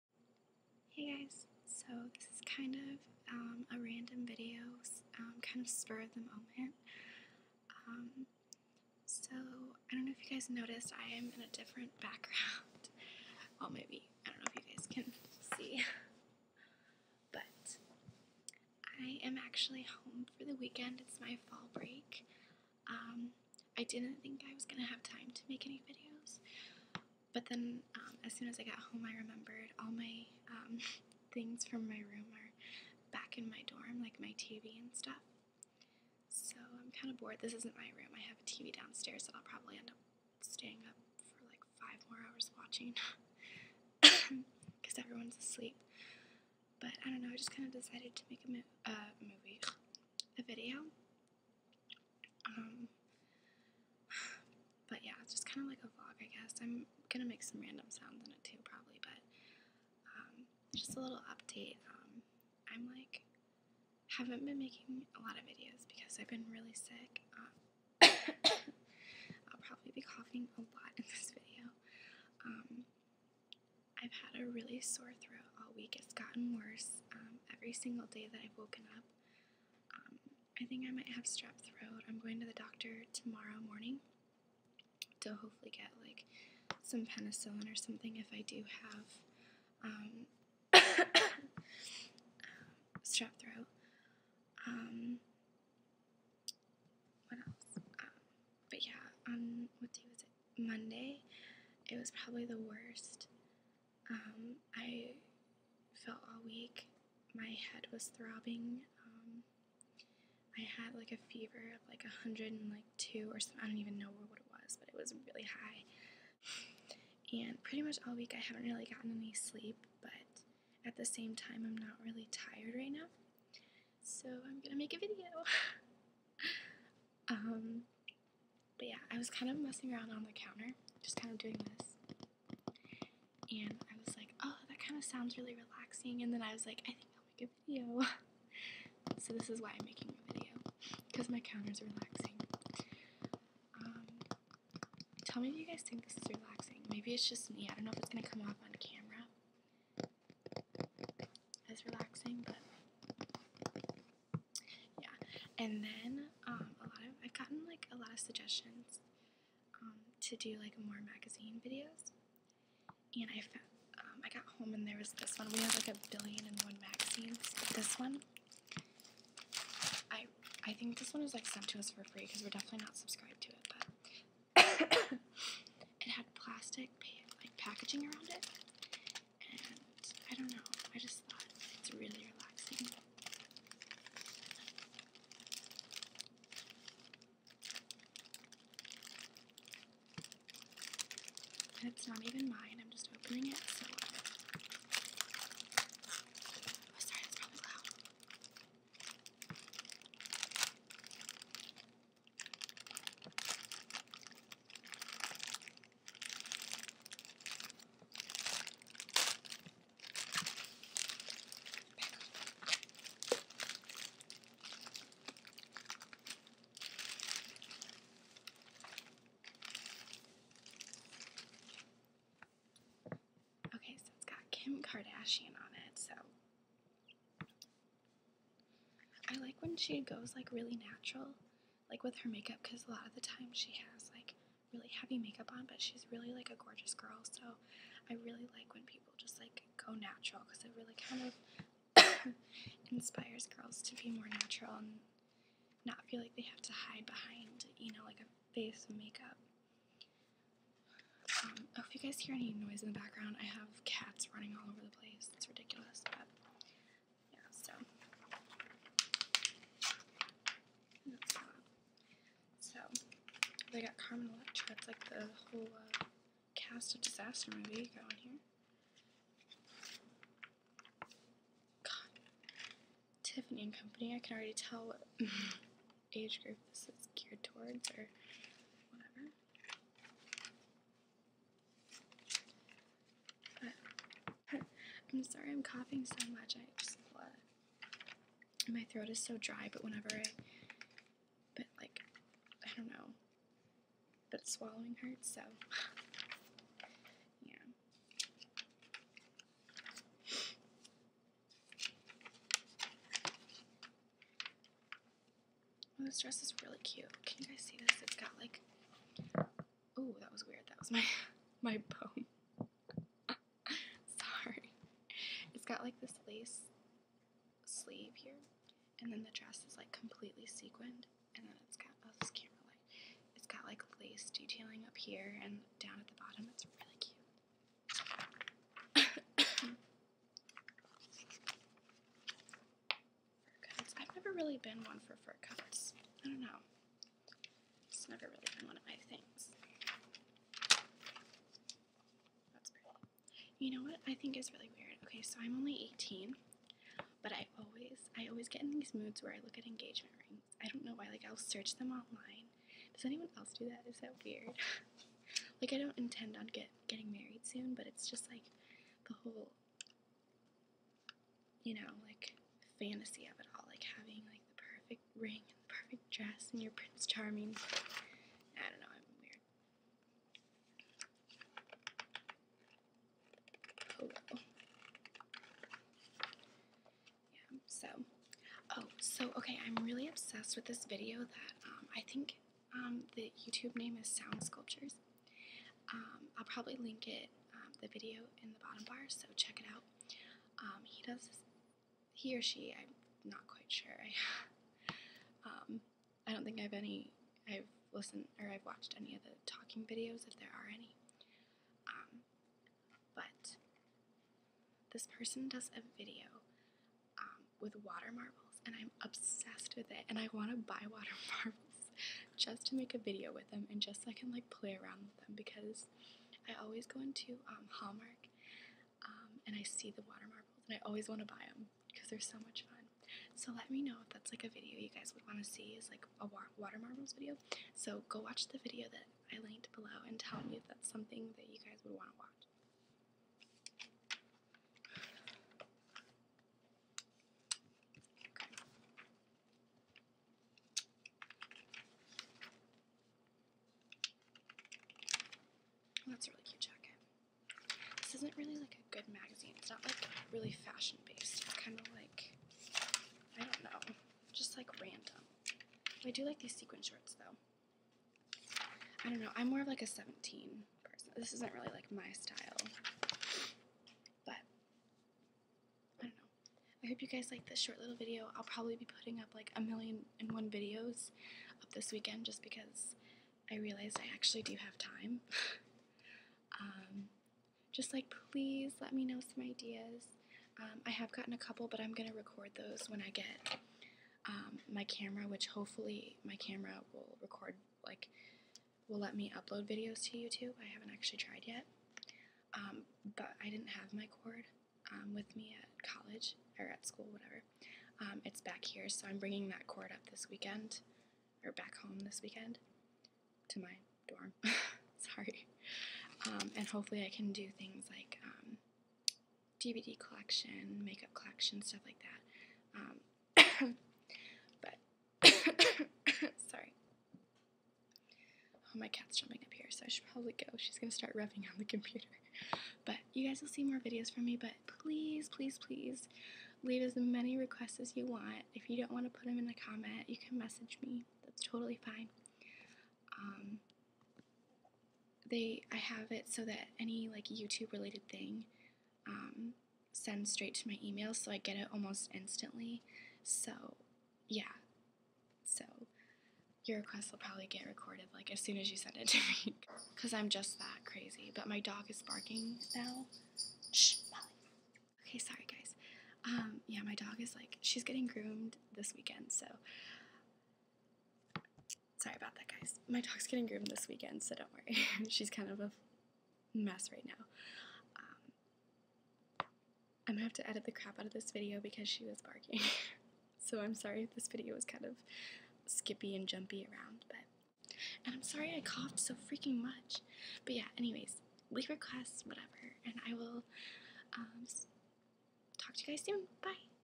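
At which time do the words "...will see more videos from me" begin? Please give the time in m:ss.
8:43.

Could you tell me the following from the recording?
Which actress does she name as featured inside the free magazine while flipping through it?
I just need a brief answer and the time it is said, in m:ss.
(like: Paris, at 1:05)
Carmen Electra, at 4:23.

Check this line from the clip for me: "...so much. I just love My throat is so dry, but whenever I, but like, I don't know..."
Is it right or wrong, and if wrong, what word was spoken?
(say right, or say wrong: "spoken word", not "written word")
right.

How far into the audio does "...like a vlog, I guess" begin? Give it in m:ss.
0:55.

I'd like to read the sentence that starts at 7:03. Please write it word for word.
So let me know if that's like a video you guys would want to see is like a water marbles video.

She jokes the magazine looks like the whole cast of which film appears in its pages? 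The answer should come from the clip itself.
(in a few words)
Disaster movie.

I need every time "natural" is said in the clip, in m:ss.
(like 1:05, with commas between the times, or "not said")
3:50, 3:59, 4:04.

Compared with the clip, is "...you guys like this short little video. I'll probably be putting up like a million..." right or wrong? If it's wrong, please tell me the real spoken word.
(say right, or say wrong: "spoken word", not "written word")
right.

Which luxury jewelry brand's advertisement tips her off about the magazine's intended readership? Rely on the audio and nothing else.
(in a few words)
Tiffany and Company.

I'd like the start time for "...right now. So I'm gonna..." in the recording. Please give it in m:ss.
2:02.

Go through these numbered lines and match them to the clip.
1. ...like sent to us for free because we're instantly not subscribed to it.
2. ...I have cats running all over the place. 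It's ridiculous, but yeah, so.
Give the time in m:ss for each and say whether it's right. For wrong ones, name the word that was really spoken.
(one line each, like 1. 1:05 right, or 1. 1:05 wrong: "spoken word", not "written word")
1. 2:51 wrong: "definitely", not "instantly"
2. 4:13 right.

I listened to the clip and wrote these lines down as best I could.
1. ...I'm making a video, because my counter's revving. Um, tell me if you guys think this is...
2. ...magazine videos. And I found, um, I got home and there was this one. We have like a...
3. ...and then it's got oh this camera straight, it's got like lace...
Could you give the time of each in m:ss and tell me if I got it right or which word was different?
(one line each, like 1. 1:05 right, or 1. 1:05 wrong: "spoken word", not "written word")
1. 2:19 wrong: "relaxing", not "revving"
2. 2:41 right
3. 5:21 wrong: "light", not "straight".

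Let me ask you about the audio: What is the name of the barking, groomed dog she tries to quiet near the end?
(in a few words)
Molly.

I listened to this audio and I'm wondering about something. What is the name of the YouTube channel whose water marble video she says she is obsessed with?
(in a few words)
Sound Sculptures.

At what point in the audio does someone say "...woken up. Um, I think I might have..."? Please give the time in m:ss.
1:18.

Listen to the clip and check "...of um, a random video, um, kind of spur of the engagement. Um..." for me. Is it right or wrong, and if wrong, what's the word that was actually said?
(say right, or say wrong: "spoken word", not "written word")
wrong: "moment", not "engagement".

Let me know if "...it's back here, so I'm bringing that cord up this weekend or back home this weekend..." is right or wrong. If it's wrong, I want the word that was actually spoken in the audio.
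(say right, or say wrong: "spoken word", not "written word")
right.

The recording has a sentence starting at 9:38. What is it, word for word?
And I'm sorry I coughed so freaking much.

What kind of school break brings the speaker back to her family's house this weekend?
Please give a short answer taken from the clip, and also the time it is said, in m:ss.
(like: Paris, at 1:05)
fall break, at 0:21.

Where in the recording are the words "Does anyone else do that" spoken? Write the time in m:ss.
5:52.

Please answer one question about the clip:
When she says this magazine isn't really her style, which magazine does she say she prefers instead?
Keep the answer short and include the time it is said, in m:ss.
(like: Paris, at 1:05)
17, at 7:39.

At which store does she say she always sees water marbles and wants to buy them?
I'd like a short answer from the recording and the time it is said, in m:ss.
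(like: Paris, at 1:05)
Hallmark, at 6:57.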